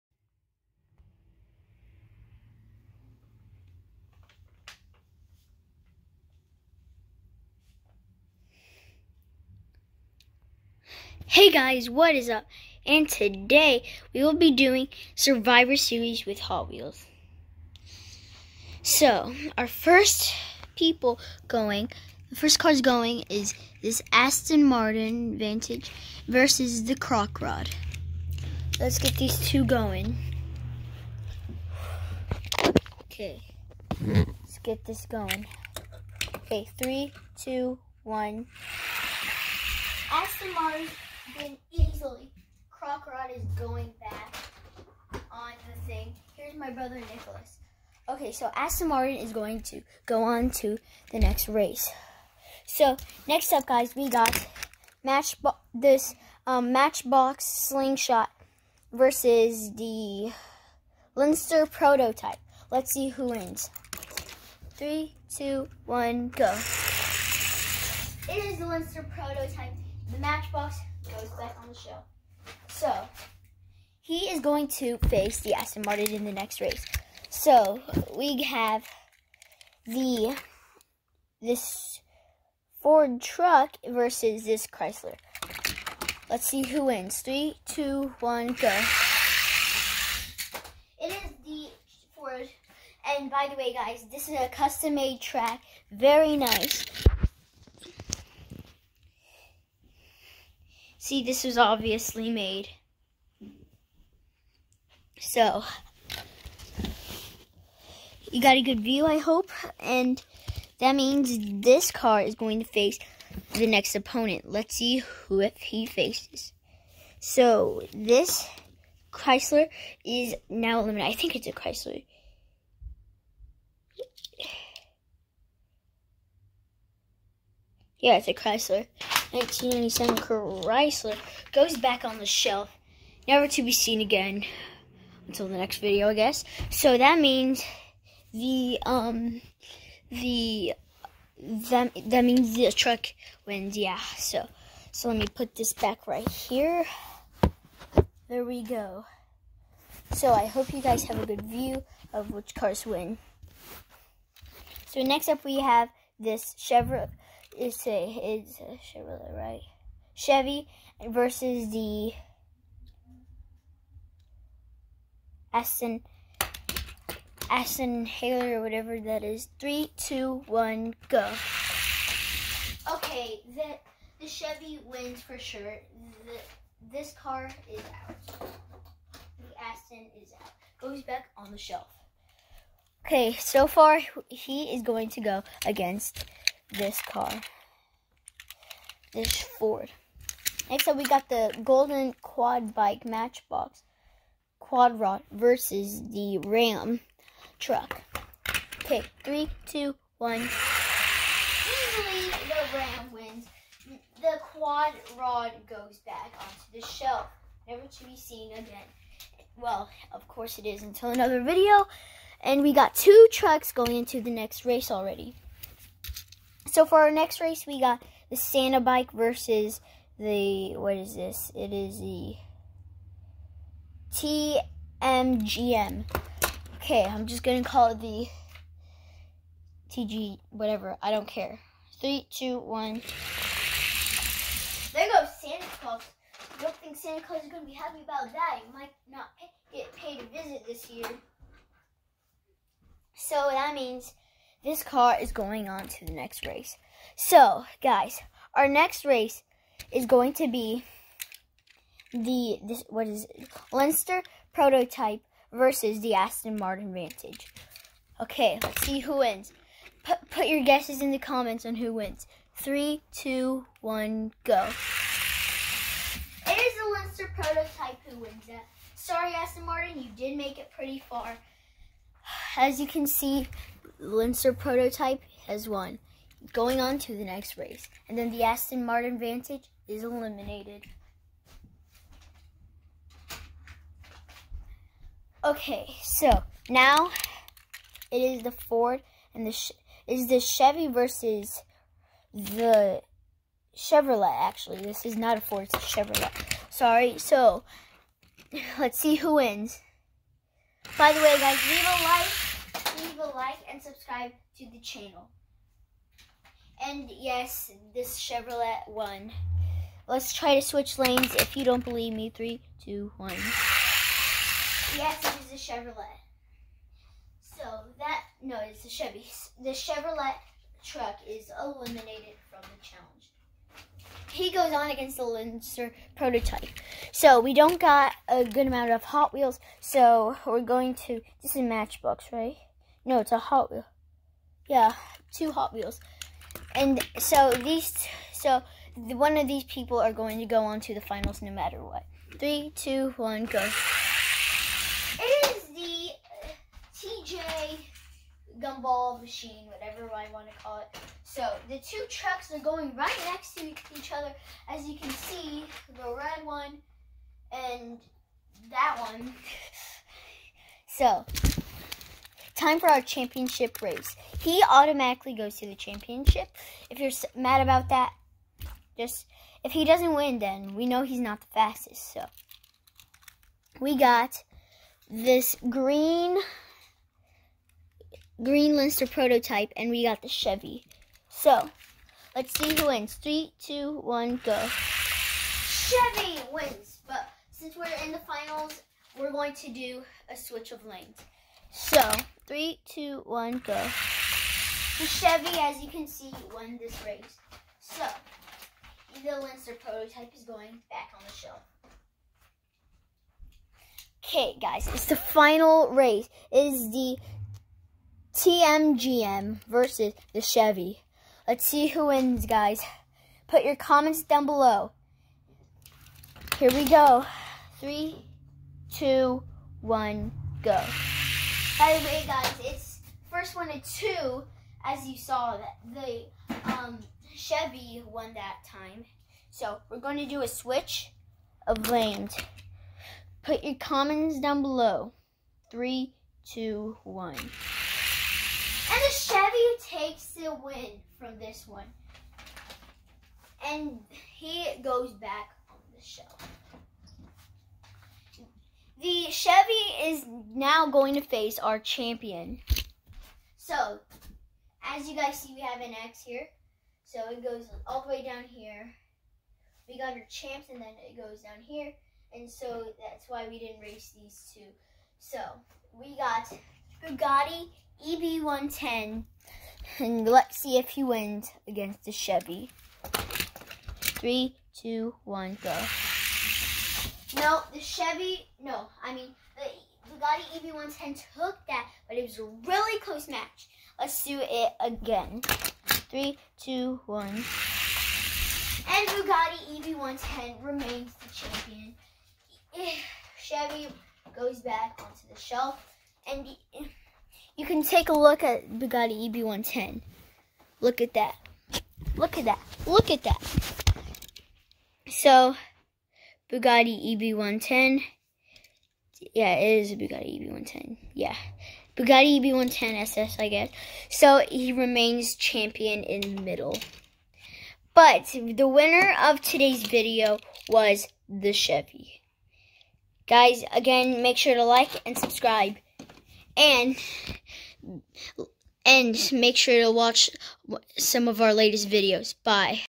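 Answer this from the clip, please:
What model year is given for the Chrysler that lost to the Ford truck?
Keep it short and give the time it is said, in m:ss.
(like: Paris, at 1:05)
1997, at 2:09.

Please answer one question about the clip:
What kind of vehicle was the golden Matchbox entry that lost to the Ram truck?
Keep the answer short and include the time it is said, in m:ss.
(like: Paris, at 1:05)
Quad bike, at 3:12.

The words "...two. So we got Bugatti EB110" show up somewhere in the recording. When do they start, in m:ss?
7:44.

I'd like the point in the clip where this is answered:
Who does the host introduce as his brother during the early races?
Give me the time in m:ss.
0:46.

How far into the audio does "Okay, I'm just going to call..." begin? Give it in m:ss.
3:46.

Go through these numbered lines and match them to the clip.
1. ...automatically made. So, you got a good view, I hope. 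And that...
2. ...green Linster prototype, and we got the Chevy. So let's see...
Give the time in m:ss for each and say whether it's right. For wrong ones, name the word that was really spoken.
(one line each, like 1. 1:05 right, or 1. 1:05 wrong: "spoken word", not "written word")
1. 1:41 wrong: "obviously", not "automatically"
2. 6:18 right.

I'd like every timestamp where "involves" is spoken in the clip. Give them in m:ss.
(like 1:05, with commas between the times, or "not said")
not said.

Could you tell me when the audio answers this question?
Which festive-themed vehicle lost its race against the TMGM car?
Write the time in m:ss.
3:38.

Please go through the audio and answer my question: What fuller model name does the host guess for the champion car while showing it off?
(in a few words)
Bugatti EB110 SS.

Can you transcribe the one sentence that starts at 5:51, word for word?
So the two trucks are going right next to each other.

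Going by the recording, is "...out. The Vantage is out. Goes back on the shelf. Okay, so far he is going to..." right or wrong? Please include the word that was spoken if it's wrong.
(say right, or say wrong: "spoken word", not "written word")
wrong: "Aston", not "Vantage".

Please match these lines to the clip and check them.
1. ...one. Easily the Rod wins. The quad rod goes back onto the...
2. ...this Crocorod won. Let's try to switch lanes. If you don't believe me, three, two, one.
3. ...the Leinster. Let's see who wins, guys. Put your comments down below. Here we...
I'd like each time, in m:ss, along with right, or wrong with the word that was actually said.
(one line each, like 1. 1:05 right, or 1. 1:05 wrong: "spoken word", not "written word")
1. 3:20 wrong: "Ram", not "Rod"
2. 5:07 wrong: "Chevrolet", not "Crocorod"
3. 6:50 wrong: "Chevy", not "Leinster".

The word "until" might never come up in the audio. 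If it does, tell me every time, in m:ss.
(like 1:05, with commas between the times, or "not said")
2:15, 3:30.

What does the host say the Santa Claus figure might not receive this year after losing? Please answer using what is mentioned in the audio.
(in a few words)
A visit.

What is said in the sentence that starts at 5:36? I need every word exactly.
And so these, so one of these people are going to go on to the finals no matter what.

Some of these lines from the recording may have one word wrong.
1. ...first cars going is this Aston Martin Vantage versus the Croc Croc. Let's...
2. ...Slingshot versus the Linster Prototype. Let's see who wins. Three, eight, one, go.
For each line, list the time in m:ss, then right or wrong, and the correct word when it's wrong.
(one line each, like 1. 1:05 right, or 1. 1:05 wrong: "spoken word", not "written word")
1. 0:22 wrong: "Rod", not "Croc"
2. 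0:57 wrong: "two", not "eight".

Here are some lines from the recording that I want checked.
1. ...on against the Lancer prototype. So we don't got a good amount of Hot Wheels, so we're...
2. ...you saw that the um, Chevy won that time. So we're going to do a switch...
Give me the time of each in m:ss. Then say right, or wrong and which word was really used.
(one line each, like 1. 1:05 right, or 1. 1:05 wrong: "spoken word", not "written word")
1. 5:24 right
2. 7:05 right.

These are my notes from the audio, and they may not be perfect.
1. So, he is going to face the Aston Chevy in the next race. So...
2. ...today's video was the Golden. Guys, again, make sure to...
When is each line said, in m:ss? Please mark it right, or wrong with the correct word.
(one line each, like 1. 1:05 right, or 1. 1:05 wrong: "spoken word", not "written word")
1. 1:12 wrong: "Martin", not "Chevy"
2. 8:39 wrong: "Chevy", not "Golden".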